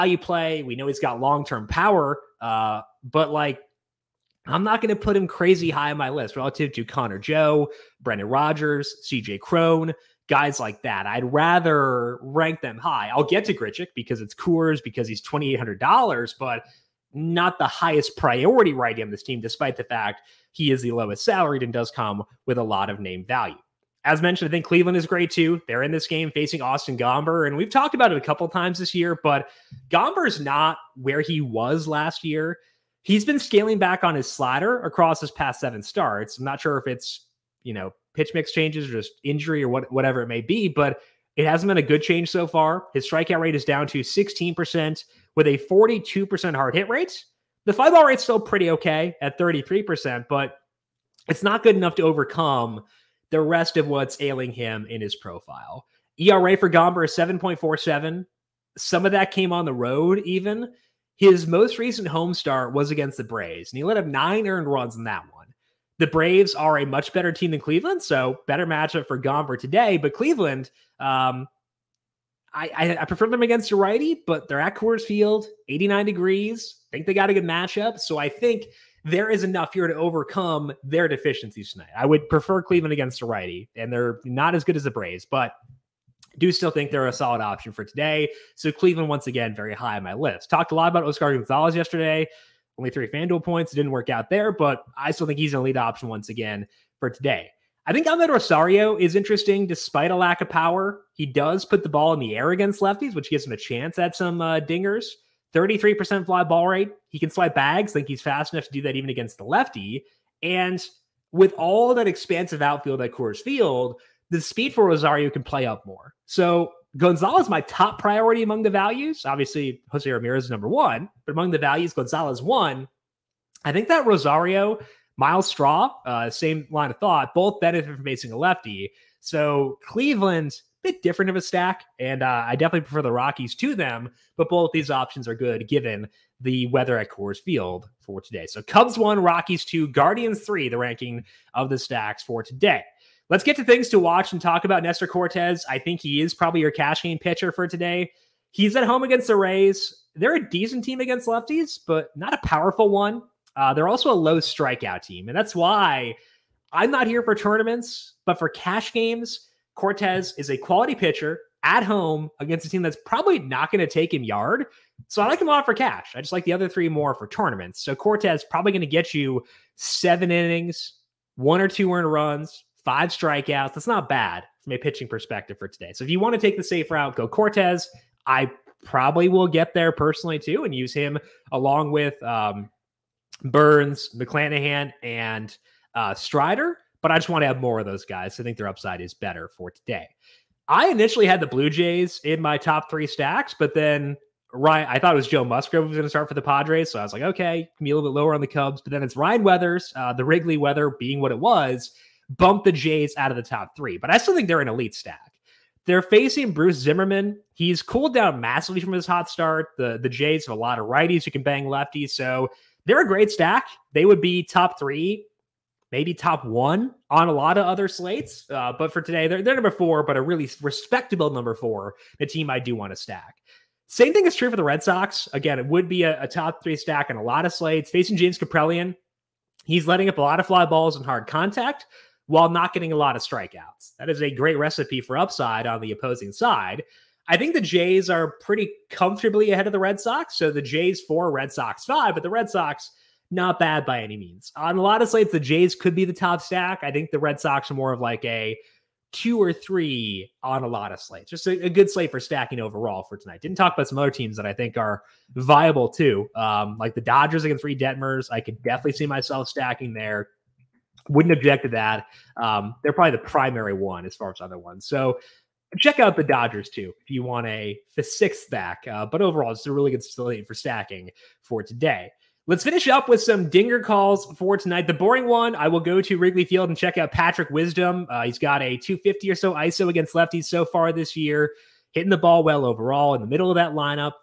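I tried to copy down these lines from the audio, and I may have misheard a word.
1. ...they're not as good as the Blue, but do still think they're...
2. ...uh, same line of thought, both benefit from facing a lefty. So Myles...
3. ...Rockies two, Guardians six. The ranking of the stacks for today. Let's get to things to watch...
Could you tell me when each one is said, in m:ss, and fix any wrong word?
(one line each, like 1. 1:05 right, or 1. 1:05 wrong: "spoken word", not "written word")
1. 1:23 wrong: "Braves", not "Blue"
2. 2:06 wrong: "Cleveland", not "Myles"
3. 2:19 wrong: "three", not "six".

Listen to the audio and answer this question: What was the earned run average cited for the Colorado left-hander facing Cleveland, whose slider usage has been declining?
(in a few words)
7.47.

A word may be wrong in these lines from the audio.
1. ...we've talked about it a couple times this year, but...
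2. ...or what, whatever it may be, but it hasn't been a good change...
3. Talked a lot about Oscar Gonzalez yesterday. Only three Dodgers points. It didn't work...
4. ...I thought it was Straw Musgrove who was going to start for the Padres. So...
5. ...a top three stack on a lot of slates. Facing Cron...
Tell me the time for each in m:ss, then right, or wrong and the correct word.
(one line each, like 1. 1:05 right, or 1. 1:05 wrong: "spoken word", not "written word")
1. 0:27 right
2. 0:39 right
3. 1:30 wrong: "FanDuel", not "Dodgers"
4. 3:14 wrong: "Joe", not "Straw"
5. 3:46 wrong: "James", not "Cron".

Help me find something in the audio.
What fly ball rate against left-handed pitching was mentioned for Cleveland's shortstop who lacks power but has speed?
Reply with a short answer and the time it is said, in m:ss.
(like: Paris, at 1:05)
33%, at 1:45.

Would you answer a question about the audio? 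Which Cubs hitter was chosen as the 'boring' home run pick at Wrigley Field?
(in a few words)
Patrick Wisdom.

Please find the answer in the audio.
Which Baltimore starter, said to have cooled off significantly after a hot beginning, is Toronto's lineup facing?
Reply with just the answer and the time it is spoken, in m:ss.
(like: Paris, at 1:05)
Bruce Zimmermann, at 3:26.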